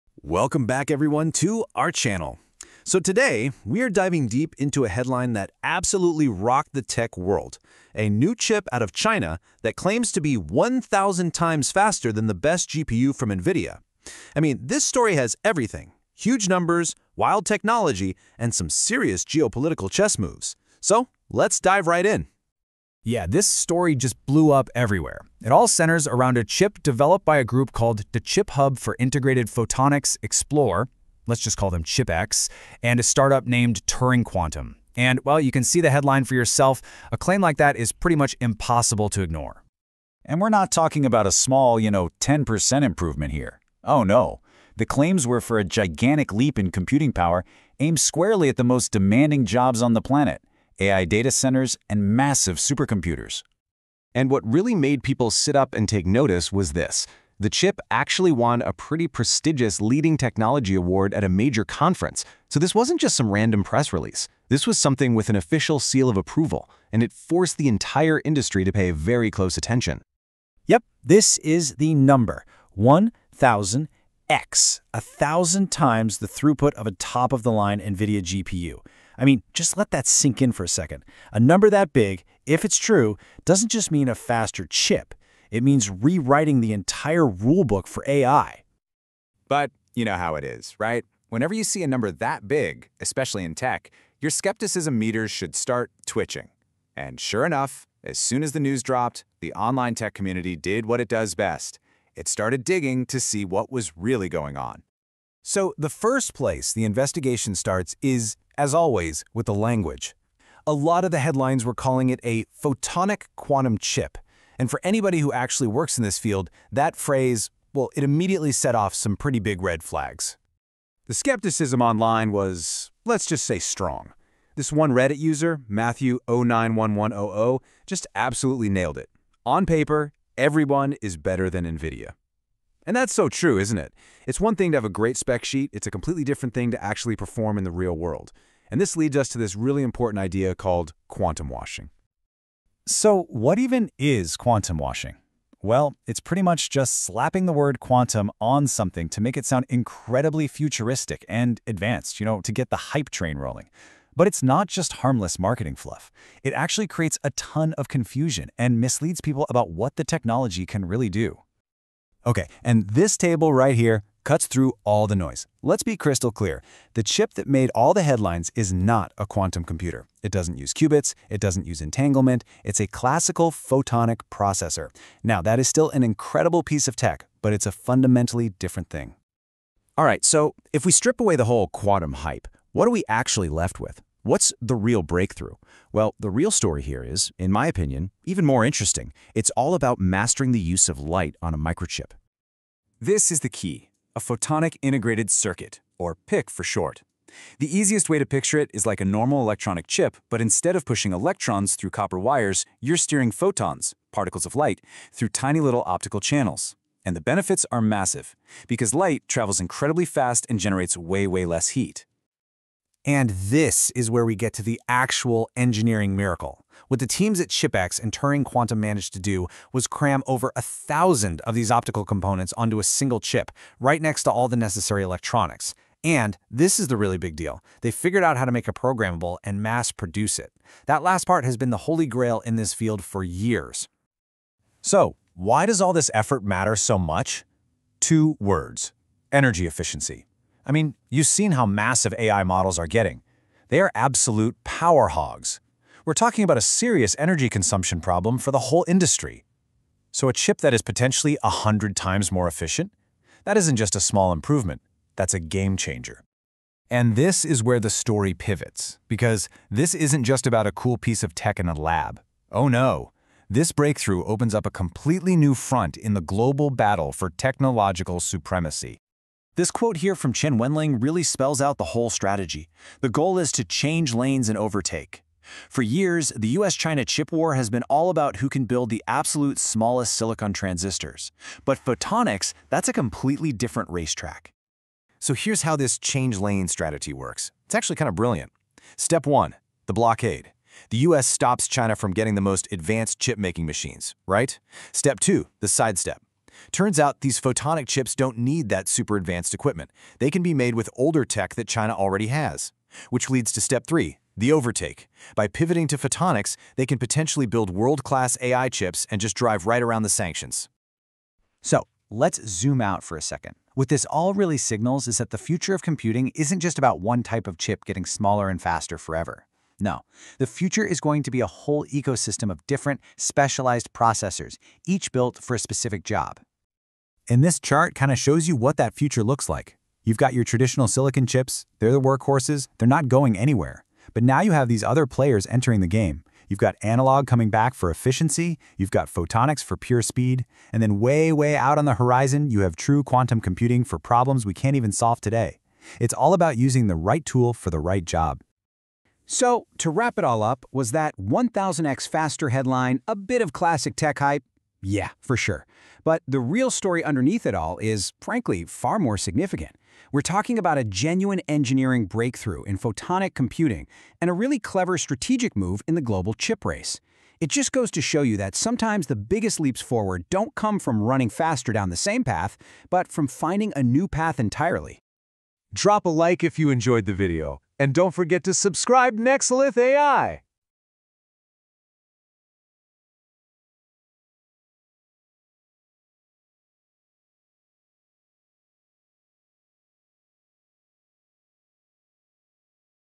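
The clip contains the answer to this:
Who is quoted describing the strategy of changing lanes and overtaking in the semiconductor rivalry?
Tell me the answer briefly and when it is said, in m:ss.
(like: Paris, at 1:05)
Chen Wenling, at 4:30.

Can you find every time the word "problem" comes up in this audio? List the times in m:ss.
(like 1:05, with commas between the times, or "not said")
4:08, 5:43.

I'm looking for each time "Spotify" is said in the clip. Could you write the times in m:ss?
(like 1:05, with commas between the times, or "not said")
not said.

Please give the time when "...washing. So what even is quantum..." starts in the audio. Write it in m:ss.
2:21.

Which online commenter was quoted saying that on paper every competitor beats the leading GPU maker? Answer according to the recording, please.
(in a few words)
Matthew091100.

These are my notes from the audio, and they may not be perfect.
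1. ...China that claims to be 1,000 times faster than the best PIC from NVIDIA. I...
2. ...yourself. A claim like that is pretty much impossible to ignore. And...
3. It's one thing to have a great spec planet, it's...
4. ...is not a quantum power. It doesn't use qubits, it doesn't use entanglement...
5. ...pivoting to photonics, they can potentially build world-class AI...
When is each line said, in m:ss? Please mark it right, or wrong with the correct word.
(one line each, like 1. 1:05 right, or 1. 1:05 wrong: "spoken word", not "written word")
1. 0:08 wrong: "GPU", not "PIC"
2. 0:36 right
3. 2:14 wrong: "sheet", not "planet"
4. 2:48 wrong: "computer", not "power"
5. 5:05 right.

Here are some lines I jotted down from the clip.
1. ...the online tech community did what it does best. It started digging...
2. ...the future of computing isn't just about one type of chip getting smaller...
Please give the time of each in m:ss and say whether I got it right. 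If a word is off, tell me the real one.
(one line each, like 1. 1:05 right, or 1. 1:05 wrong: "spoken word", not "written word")
1. 1:39 right
2. 5:15 right.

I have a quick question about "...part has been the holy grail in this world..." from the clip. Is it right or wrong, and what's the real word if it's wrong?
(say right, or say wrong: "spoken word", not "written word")
wrong: "field", not "world".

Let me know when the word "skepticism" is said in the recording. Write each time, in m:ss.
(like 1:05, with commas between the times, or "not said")
1:34, 2:01.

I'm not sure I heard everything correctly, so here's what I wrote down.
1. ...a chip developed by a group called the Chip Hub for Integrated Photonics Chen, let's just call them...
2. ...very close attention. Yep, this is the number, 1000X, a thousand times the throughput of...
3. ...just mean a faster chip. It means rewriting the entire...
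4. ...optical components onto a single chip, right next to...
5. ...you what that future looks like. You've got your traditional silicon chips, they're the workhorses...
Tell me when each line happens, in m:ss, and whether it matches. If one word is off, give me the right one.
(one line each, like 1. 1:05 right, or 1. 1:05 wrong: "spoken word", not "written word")
1. 0:26 wrong: "Xplore", not "Chen"
2. 1:08 right
3. 1:23 right
4. 3:41 right
5. 5:28 right.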